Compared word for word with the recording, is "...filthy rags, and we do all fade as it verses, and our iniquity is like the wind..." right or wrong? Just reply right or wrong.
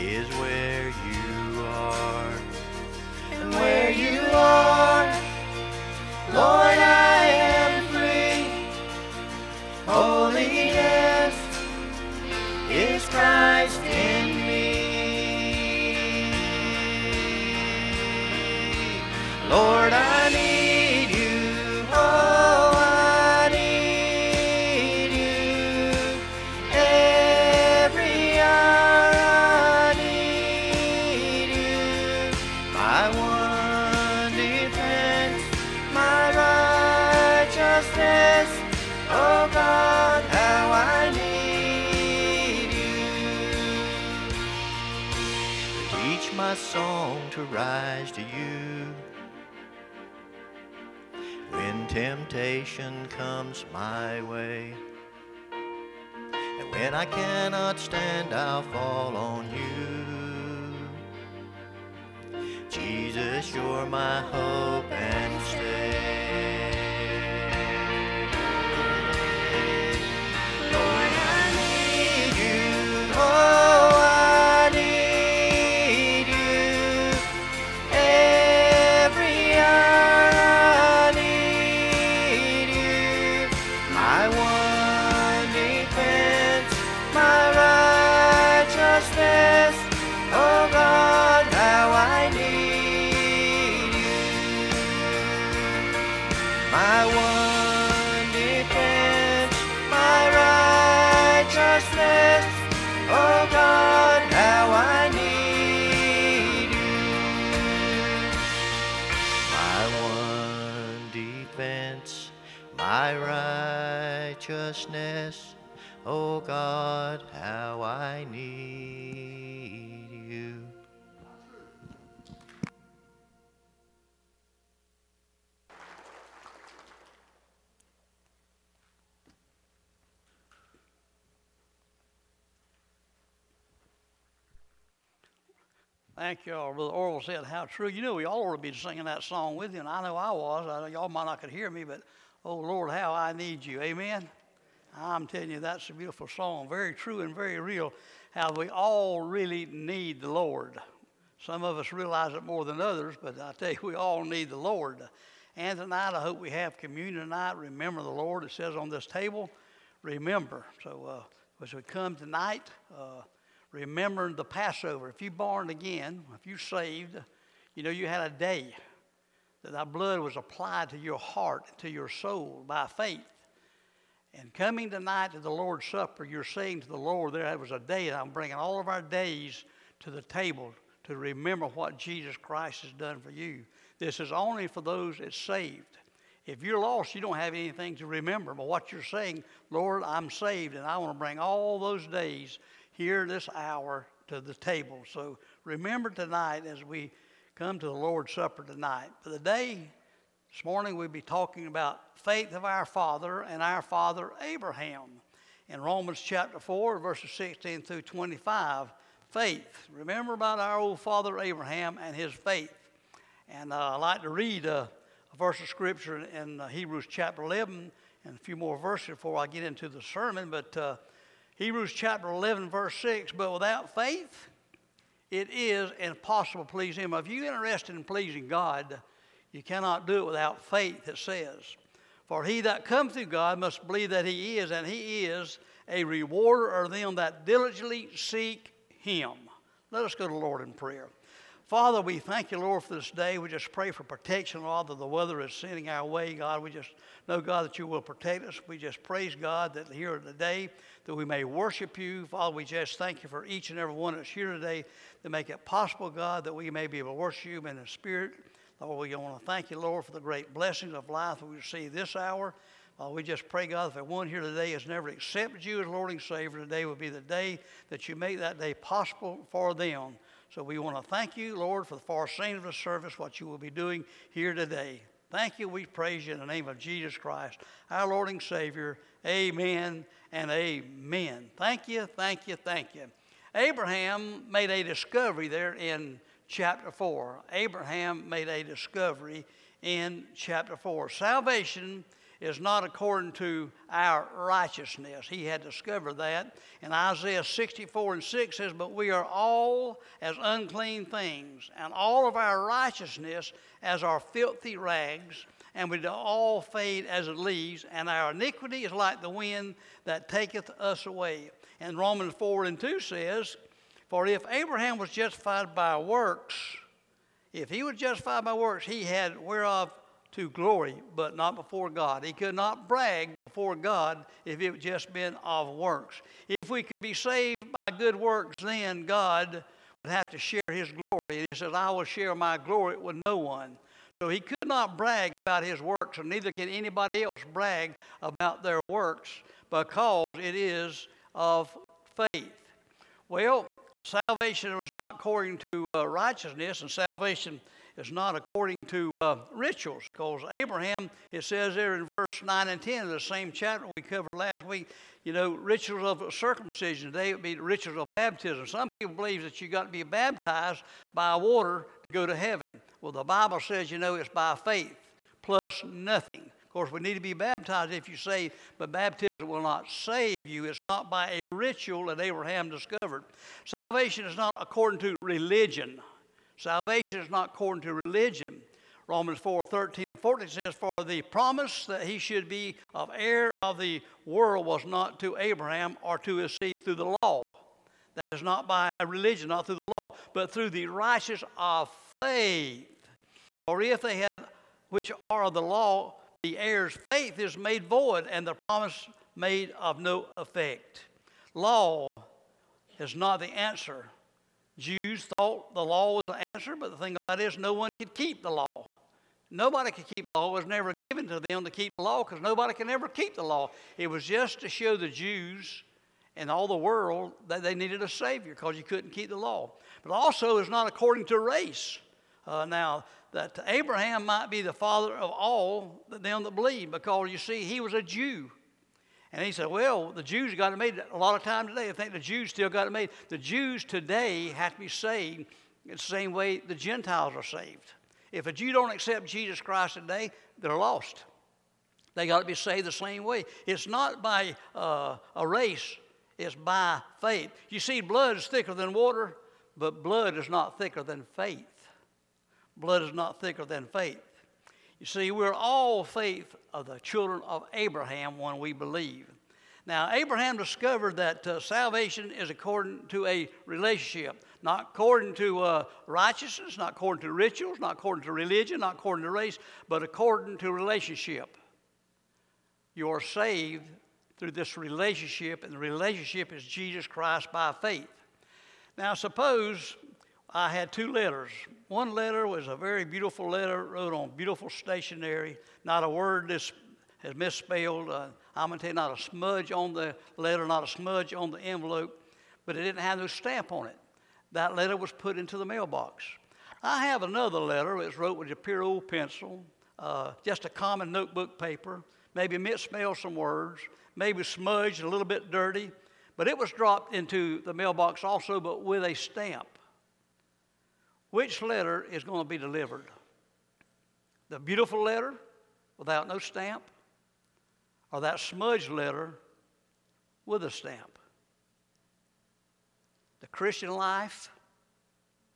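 wrong.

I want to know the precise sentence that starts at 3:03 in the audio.
This is only for those that's saved.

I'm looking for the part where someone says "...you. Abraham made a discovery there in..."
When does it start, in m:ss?
4:42.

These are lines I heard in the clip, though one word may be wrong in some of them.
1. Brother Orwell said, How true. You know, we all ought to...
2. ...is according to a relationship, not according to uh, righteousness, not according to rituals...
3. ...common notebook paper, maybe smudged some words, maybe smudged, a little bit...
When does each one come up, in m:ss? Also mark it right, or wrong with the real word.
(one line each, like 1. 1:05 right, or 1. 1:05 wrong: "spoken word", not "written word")
1. 2:16 right
2. 7:42 right
3. 8:20 wrong: "misspelled", not "smudged".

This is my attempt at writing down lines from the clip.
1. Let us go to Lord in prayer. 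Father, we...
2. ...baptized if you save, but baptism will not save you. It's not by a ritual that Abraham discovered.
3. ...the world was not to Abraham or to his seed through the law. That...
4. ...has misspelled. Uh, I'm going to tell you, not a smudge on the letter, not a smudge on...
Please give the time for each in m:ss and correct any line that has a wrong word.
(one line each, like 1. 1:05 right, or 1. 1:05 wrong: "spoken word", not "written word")
1. 3:59 right
2. 6:07 right
3. 6:23 right
4. 8:07 right.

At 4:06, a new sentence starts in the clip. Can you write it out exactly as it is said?
We just know, God, that you will protect us.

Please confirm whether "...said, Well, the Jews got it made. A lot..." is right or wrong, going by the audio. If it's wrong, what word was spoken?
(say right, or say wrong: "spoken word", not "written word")
right.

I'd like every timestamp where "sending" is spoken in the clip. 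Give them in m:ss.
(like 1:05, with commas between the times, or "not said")
4:05.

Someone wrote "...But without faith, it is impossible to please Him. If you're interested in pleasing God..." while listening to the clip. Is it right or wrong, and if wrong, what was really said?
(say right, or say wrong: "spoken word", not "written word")
right.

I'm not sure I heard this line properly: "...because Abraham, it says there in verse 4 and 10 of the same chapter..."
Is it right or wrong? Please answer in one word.
wrong.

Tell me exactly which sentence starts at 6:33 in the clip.
For if they had, which are of the law, be heirs, faith is made void, and the promise made of no effect.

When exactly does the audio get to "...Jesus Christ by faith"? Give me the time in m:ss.
7:56.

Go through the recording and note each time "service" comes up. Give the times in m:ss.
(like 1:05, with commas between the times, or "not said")
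4:32.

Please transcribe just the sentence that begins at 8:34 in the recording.
The beautiful letter without no stamp, or that smudged letter with a stamp?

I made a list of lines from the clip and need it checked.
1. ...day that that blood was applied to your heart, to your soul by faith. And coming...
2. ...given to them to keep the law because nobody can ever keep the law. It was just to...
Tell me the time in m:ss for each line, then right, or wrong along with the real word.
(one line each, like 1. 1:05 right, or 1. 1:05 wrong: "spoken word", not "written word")
1. 2:48 right
2. 6:50 right.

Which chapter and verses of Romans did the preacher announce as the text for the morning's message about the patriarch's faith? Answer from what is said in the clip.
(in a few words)
Romans 4:16-25.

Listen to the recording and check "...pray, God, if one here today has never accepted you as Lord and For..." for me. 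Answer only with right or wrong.
wrong.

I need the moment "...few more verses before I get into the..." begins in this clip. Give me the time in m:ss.
3:38.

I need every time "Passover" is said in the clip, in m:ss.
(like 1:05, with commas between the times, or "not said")
2:44.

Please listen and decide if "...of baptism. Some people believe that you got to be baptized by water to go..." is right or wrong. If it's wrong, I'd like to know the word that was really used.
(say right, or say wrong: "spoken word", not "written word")
right.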